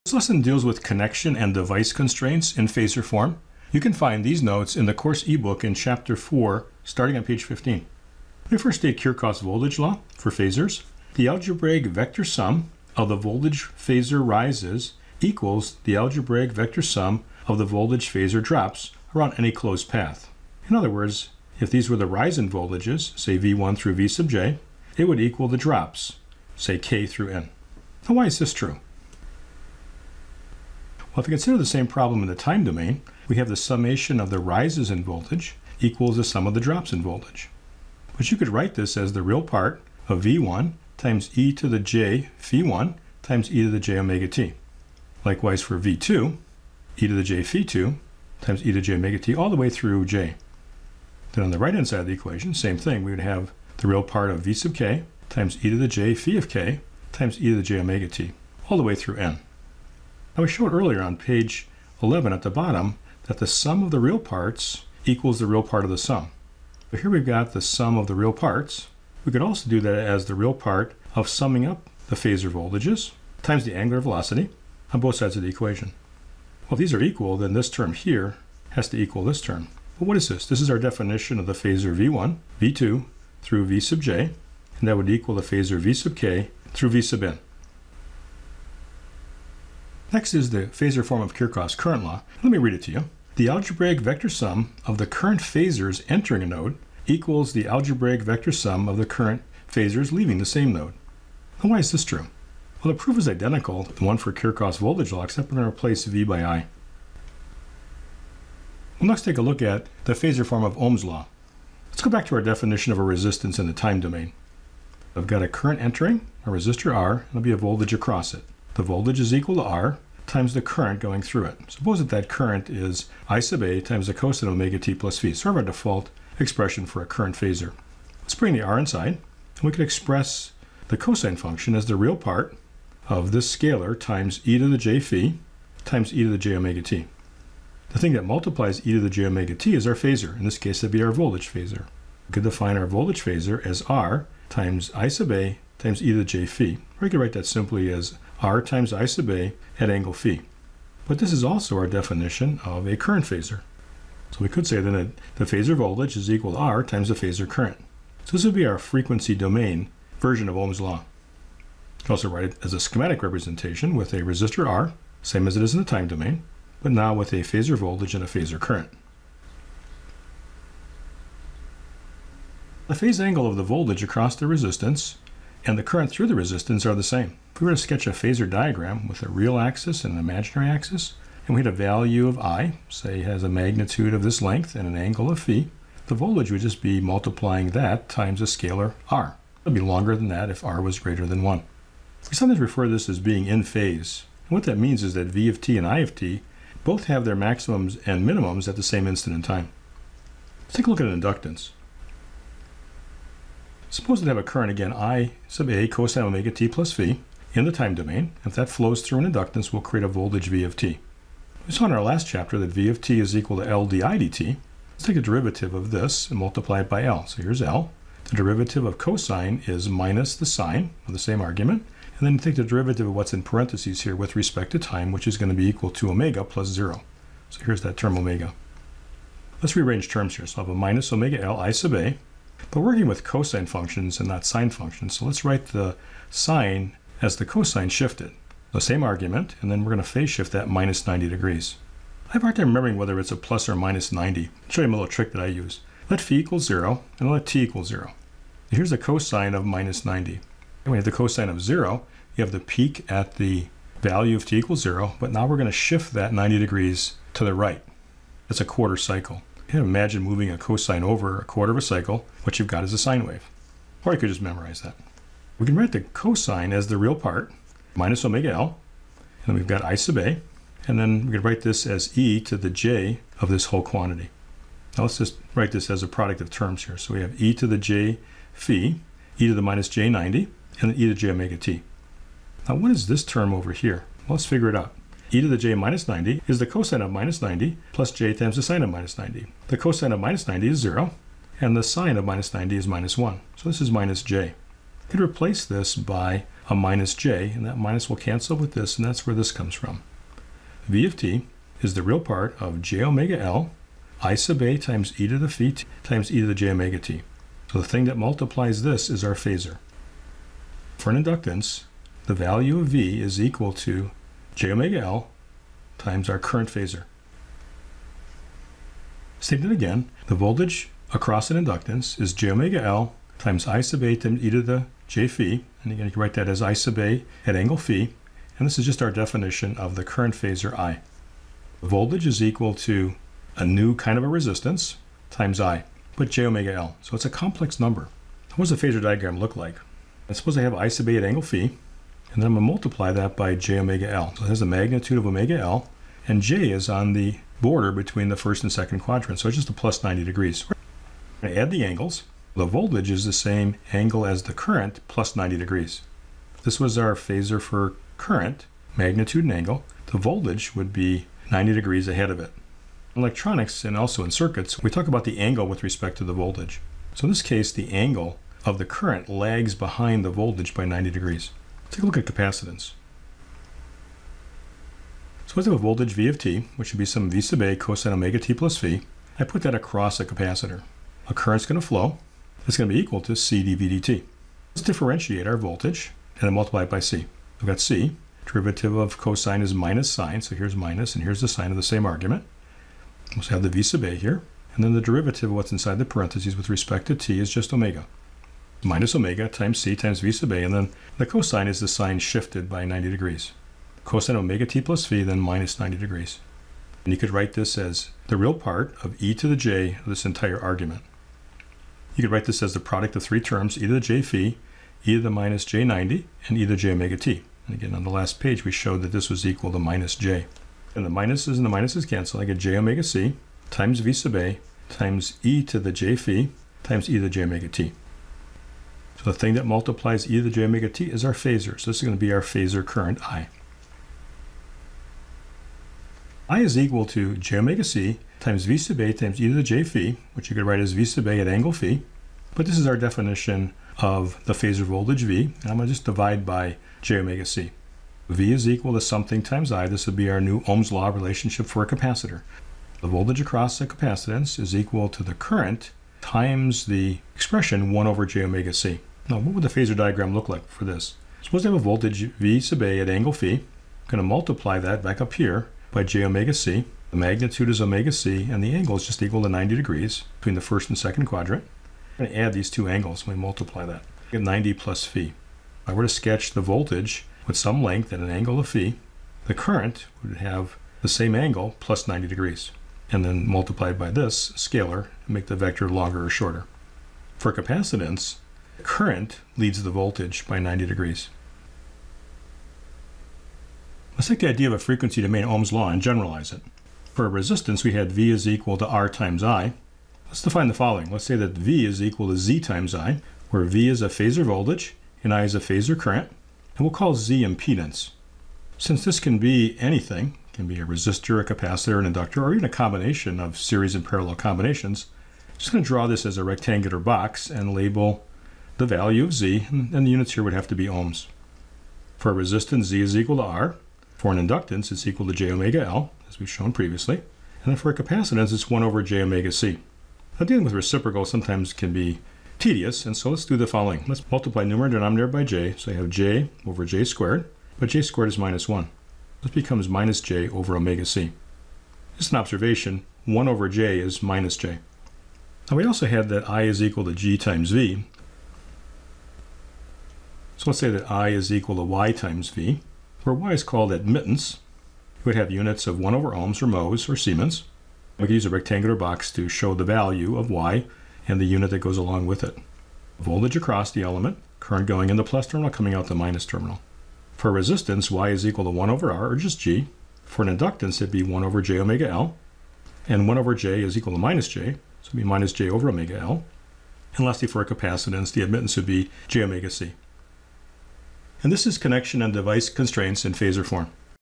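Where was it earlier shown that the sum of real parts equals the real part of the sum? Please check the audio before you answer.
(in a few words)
Page 11.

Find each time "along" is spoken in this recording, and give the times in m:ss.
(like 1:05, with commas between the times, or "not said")
9:21.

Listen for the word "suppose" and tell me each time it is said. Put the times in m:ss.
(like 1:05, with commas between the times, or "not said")
2:01, 3:23, 5:40, 7:41.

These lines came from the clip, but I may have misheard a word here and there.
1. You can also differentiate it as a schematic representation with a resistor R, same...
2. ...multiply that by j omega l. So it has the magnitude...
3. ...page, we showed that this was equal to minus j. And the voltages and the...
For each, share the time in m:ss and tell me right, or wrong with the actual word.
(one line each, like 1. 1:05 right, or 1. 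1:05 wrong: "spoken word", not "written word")
1. 2:41 wrong: "write", not "differentiate"
2. 5:42 right
3. 6:58 wrong: "minuses", not "voltages".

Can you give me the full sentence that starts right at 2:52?
The phase angle of the voltage across the resistance and the current through the resistance are the same.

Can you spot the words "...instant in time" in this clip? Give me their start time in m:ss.
3:19.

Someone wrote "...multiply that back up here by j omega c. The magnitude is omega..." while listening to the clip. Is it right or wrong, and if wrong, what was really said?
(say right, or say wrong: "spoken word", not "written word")
right.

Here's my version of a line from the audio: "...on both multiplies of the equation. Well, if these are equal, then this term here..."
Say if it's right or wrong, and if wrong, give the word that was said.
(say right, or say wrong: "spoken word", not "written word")
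wrong: "sides", not "multiplies".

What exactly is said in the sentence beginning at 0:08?
We first state Kirchhoff's voltage law for phasors.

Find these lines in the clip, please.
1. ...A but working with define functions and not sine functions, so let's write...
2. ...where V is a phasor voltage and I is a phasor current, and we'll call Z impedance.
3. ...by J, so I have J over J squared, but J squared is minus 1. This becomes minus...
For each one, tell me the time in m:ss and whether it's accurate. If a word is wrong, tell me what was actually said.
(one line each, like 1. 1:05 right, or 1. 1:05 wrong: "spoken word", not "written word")
1. 3:51 wrong: "cosine", not "define"
2. 8:23 right
3. 8:55 right.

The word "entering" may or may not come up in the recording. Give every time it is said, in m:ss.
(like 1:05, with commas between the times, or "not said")
1:36, 1:55.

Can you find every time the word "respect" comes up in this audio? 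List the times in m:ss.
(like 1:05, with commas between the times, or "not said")
3:44, 6:05, 6:36.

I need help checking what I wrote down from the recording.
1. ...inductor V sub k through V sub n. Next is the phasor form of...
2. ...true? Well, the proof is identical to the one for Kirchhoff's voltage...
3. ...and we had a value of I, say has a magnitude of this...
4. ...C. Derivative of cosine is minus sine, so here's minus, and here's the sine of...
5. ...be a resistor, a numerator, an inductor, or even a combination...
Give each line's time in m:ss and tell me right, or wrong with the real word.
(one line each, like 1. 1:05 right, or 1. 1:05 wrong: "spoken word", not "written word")
1. 1:25 wrong: "phasor", not "inductor"
2. 1:42 right
3. 3:01 right
4. 6:27 right
5. 8:30 wrong: "capacitor", not "numerator".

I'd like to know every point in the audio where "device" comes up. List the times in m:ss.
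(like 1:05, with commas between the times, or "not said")
0:01, 9:42.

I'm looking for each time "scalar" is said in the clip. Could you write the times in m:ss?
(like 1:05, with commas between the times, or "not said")
2:13, 3:08, 8:04.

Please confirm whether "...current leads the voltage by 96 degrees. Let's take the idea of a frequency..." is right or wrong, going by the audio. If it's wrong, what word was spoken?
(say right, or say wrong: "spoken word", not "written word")
wrong: "90", not "96".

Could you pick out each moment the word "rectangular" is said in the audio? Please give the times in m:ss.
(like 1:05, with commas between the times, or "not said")
8:36, 9:18.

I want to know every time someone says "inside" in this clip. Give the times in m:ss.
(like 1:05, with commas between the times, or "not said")
2:08, 6:35.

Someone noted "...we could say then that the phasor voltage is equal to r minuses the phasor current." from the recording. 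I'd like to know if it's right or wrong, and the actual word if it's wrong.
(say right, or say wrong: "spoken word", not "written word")
wrong: "times", not "minuses".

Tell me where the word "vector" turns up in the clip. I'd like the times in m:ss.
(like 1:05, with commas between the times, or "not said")
0:11, 0:16, 1:34, 1:38, 8:05.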